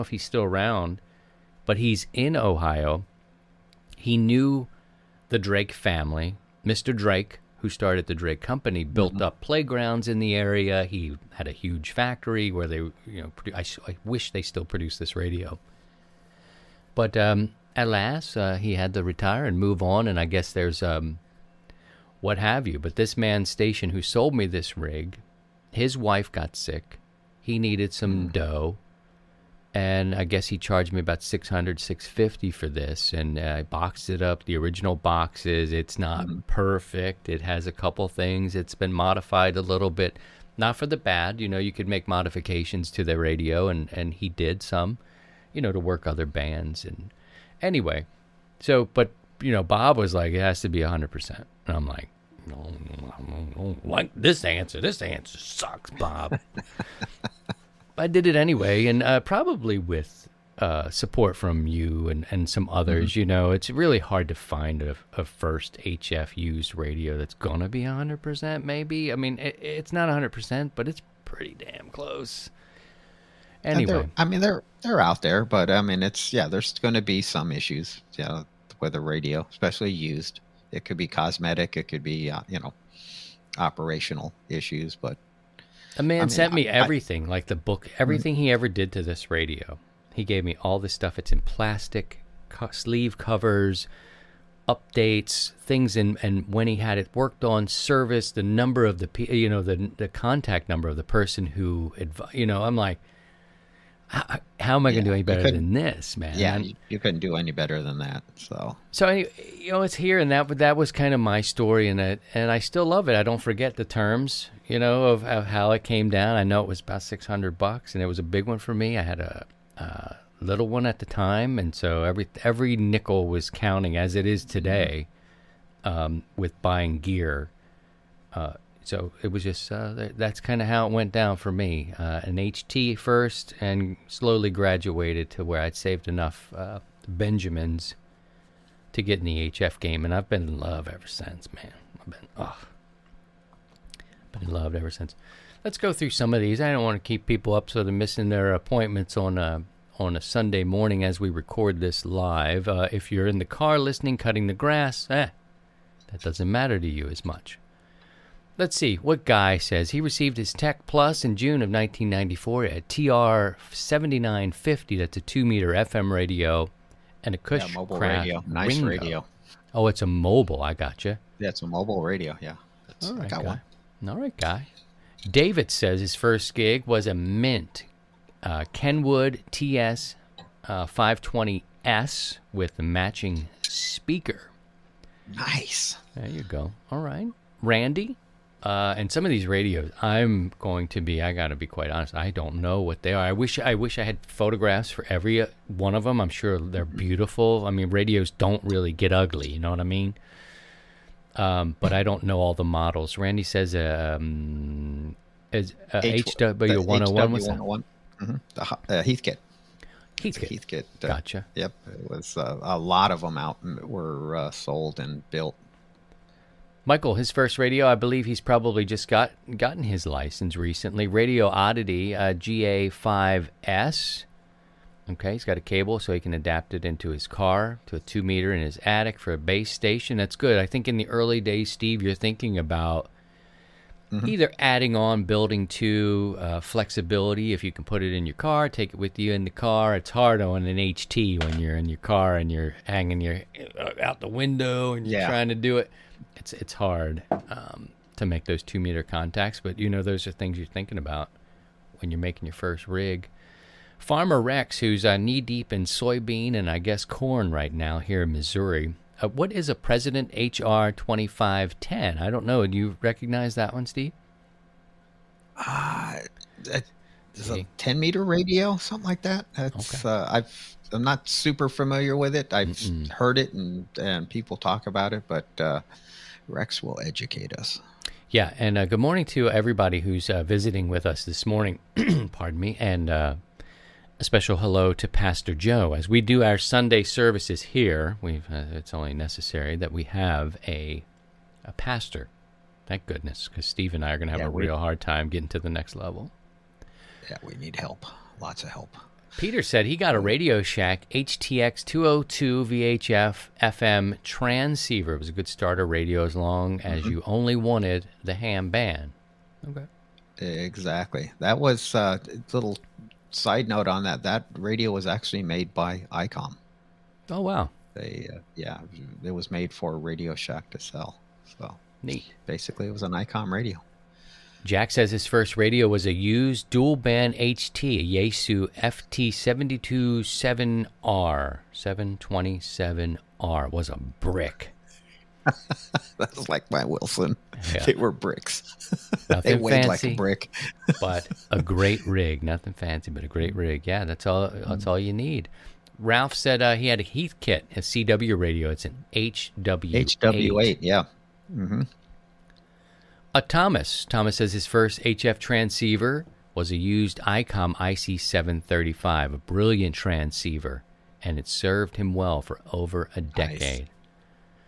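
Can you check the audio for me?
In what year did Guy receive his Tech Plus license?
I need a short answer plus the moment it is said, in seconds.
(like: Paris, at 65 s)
1994, at 161 s.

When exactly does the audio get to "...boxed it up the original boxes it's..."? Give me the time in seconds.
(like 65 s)
33 s.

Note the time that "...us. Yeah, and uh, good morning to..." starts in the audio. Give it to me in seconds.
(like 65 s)
277 s.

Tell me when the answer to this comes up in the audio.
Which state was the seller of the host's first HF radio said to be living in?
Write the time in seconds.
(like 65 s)
2 s.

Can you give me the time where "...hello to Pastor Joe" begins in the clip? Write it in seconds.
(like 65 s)
284 s.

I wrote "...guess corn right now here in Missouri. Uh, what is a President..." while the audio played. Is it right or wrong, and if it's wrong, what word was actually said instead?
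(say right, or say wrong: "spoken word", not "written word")
right.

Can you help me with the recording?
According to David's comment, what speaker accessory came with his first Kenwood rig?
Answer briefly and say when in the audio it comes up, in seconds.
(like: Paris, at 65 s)
the matching speaker, at 182 s.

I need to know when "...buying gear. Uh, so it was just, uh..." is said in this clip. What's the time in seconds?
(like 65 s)
126 s.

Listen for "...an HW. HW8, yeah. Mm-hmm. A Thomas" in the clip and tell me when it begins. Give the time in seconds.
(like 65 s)
348 s.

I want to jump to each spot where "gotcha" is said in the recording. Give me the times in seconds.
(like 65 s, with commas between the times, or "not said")
170 s, 211 s.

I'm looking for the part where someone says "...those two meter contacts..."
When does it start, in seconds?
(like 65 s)
248 s.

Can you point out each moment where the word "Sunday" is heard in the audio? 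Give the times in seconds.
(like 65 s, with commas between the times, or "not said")
150 s, 286 s.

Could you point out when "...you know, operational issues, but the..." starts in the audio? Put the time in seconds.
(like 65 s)
82 s.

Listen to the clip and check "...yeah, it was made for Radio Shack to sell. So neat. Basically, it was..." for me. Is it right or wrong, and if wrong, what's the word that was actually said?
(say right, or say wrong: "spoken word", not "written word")
right.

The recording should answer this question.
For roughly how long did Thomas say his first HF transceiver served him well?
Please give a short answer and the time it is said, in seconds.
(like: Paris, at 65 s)
over a decade, at 362 s.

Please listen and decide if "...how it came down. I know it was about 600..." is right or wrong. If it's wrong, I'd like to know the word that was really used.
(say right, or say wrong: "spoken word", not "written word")
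right.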